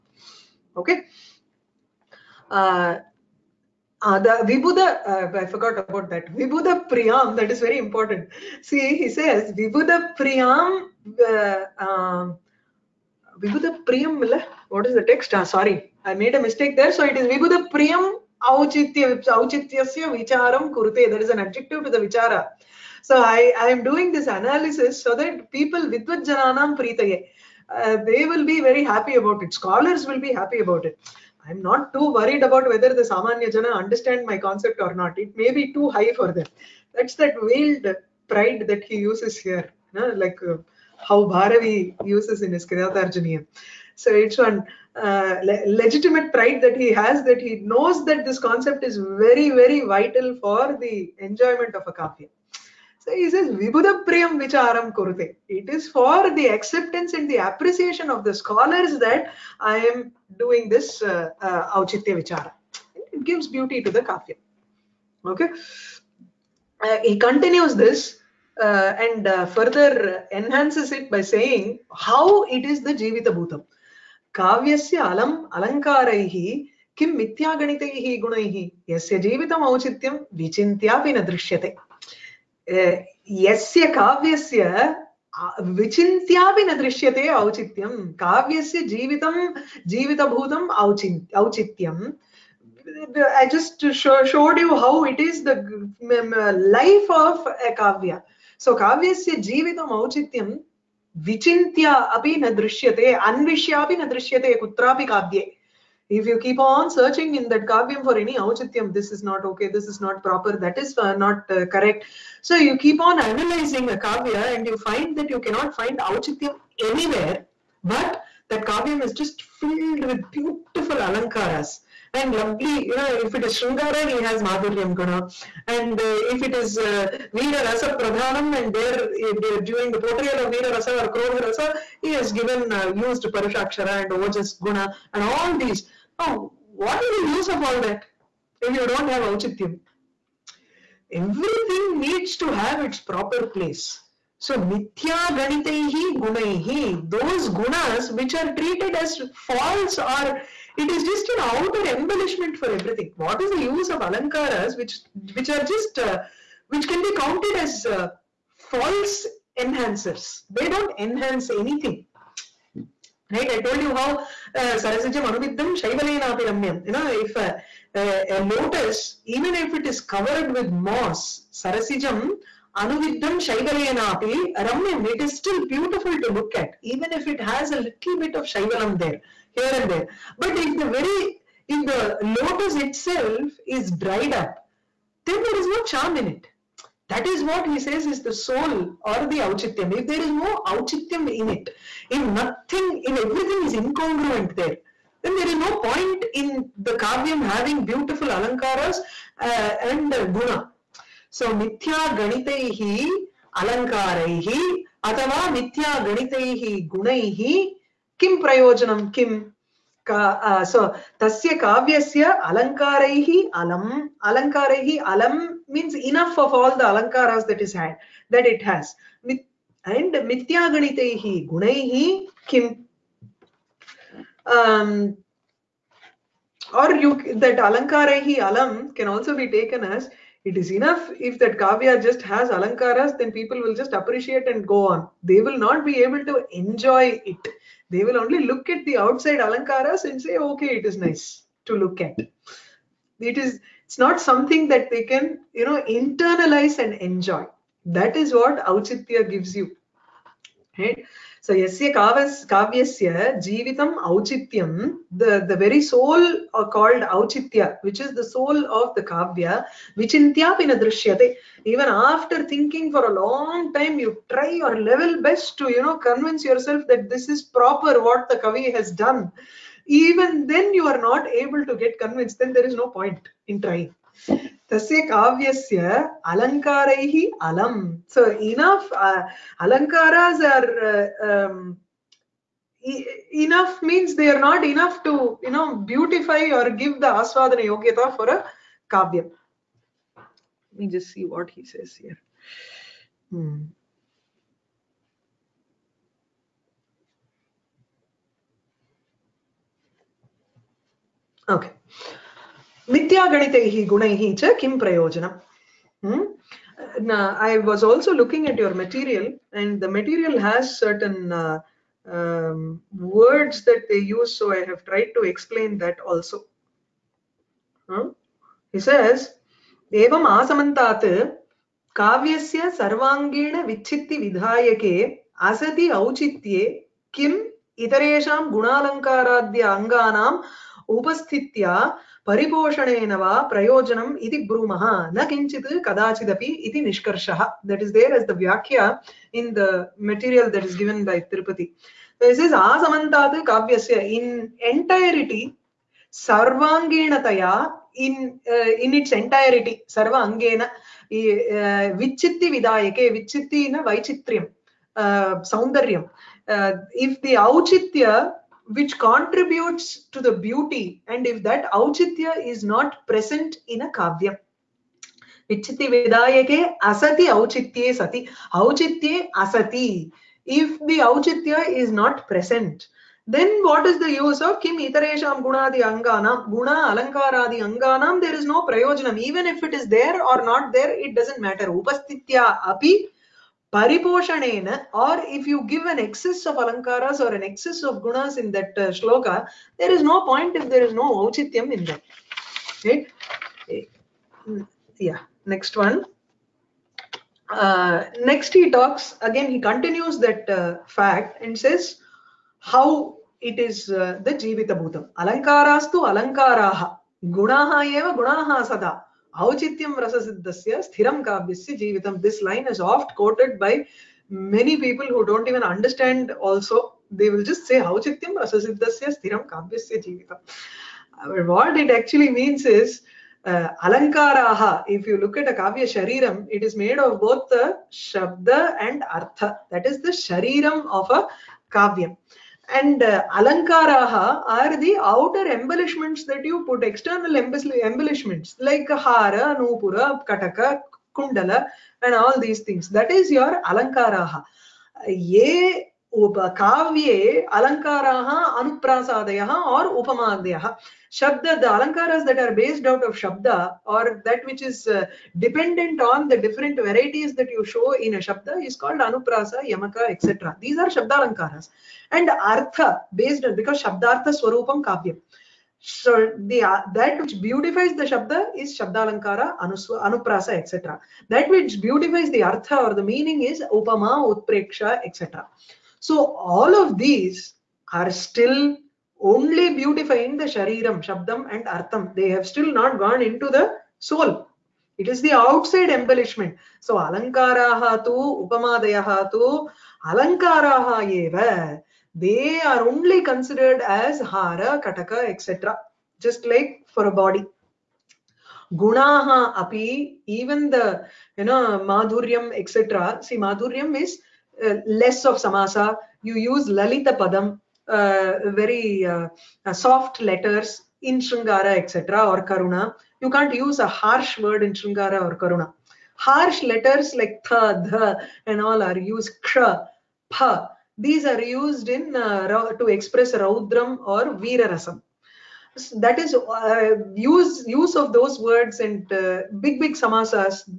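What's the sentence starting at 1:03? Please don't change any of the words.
It gives beauty to the kafya.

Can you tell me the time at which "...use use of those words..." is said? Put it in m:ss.
8:47.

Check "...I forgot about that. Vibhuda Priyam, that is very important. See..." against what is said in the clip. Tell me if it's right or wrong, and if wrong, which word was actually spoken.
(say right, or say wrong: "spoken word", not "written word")
right.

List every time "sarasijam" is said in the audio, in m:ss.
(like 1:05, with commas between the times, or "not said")
2:44, 2:51.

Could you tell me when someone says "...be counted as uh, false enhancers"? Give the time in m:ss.
2:37.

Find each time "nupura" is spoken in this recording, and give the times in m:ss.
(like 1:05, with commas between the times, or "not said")
7:19.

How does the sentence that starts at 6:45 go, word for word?
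Alankarastu alankaraha, gunaha eva gunaha sada.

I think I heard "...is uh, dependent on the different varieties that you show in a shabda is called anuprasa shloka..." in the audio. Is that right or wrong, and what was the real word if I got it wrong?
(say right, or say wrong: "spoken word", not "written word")
wrong: "yamaka", not "shloka".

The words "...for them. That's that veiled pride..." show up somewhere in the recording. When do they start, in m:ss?
0:36.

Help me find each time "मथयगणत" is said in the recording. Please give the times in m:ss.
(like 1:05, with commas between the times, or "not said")
1:17.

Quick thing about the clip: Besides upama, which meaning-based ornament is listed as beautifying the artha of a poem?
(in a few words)
utpreksha.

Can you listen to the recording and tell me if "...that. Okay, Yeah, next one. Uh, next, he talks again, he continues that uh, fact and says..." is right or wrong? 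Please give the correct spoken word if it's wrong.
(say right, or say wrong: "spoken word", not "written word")
right.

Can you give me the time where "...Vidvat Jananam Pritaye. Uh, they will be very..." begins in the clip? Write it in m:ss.
0:25.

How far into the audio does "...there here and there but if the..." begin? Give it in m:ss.
2:59.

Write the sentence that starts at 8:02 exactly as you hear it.
They have still not gone into the soul.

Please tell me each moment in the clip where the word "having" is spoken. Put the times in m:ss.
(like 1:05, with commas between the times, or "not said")
3:17.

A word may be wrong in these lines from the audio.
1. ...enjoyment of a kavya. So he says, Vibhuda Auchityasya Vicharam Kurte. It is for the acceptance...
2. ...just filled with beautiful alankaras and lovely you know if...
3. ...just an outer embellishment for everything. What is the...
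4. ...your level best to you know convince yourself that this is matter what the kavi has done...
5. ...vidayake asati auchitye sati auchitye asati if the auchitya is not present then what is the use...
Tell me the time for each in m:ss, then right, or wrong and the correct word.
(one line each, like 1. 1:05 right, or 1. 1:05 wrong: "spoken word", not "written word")
1. 0:51 wrong: "Prem", not "Auchityasya"
2. 1:59 right
3. 2:31 right
4. 4:24 wrong: "proper", not "matter"
5. 6:05 right.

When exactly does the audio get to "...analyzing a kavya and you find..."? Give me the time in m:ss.
1:53.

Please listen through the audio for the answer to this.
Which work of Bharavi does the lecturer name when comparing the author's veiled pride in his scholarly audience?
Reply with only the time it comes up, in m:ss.
0:42.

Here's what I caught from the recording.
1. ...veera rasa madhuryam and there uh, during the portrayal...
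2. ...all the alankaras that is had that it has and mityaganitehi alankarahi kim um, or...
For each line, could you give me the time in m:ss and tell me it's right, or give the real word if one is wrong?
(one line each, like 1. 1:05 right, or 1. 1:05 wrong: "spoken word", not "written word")
1. 2:07 wrong: "pradhanam", not "madhuryam"
2. 3:36 wrong: "gunaihi", not "alankarahi".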